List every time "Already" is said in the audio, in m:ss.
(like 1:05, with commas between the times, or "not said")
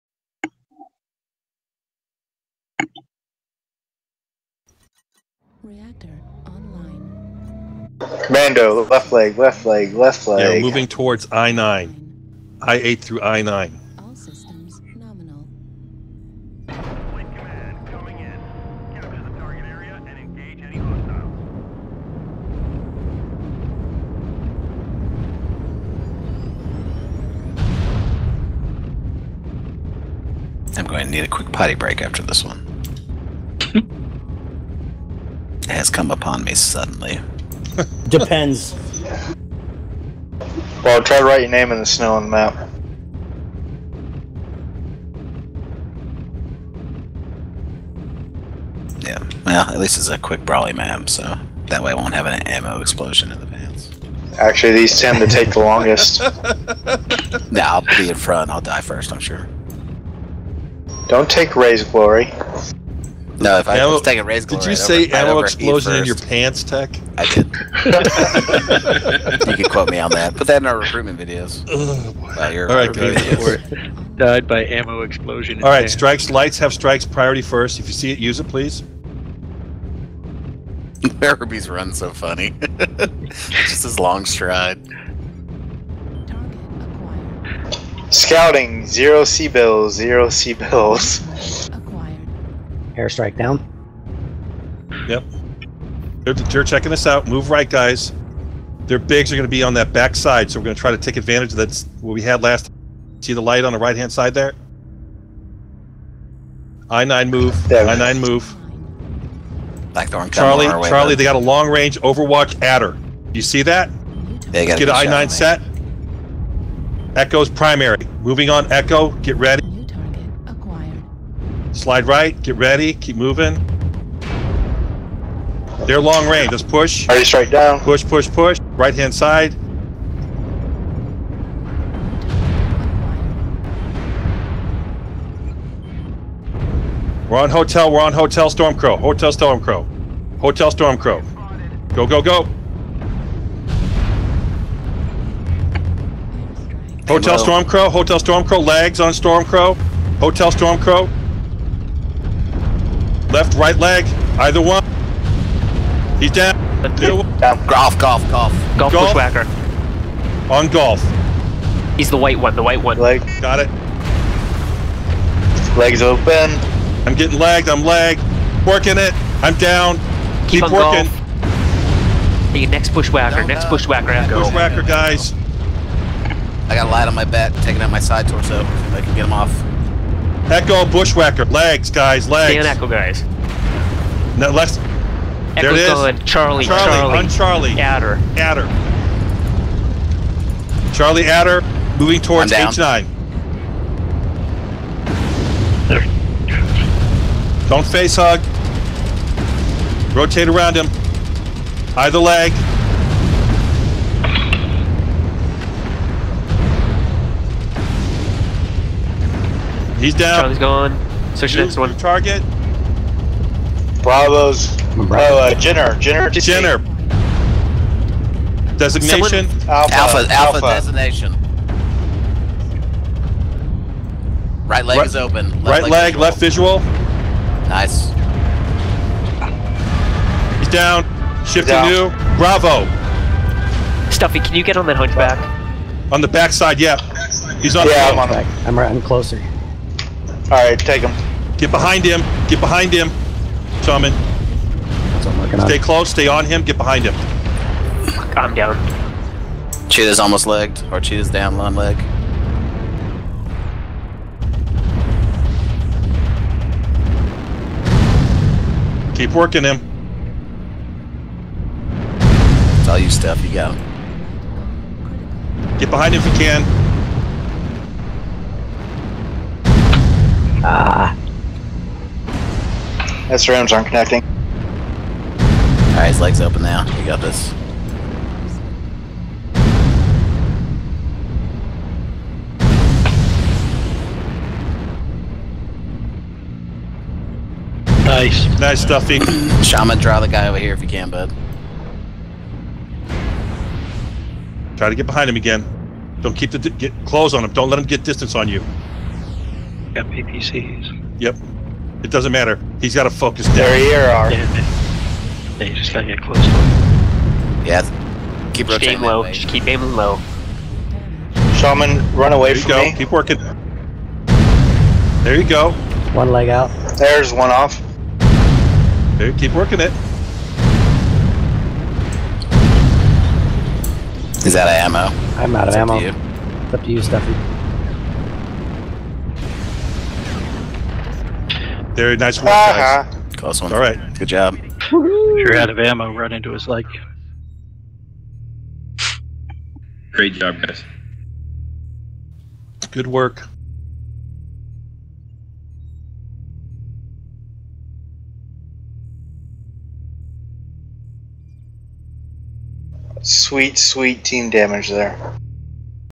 2:07.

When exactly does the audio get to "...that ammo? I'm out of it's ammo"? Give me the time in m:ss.
5:24.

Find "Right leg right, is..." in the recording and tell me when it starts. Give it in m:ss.
3:44.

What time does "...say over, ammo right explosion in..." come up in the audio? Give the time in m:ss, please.
1:04.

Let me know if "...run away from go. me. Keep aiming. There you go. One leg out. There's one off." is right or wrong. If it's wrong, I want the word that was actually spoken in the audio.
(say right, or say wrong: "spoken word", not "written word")
wrong: "working", not "aiming".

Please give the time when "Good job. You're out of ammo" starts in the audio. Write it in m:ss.
5:34.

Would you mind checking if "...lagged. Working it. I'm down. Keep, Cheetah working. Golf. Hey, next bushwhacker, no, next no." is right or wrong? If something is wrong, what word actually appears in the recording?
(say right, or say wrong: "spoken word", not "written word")
wrong: "Keep", not "Cheetah".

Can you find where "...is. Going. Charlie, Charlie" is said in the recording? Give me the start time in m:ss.
3:05.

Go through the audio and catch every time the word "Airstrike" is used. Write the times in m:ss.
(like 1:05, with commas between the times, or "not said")
1:32.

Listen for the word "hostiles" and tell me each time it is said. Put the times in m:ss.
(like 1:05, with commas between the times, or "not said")
0:20.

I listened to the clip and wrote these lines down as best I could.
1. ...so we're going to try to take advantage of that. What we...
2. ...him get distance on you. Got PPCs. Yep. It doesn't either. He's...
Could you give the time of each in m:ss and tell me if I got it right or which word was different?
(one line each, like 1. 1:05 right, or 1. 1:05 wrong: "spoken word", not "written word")
1. 1:40 right
2. 4:57 wrong: "matter", not "either".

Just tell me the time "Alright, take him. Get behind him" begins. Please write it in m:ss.
4:00.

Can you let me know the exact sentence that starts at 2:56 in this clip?
I got a light on my back, taking out my side torso.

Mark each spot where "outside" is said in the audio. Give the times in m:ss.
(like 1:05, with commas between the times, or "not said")
not said.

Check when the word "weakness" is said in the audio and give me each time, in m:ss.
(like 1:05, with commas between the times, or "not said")
not said.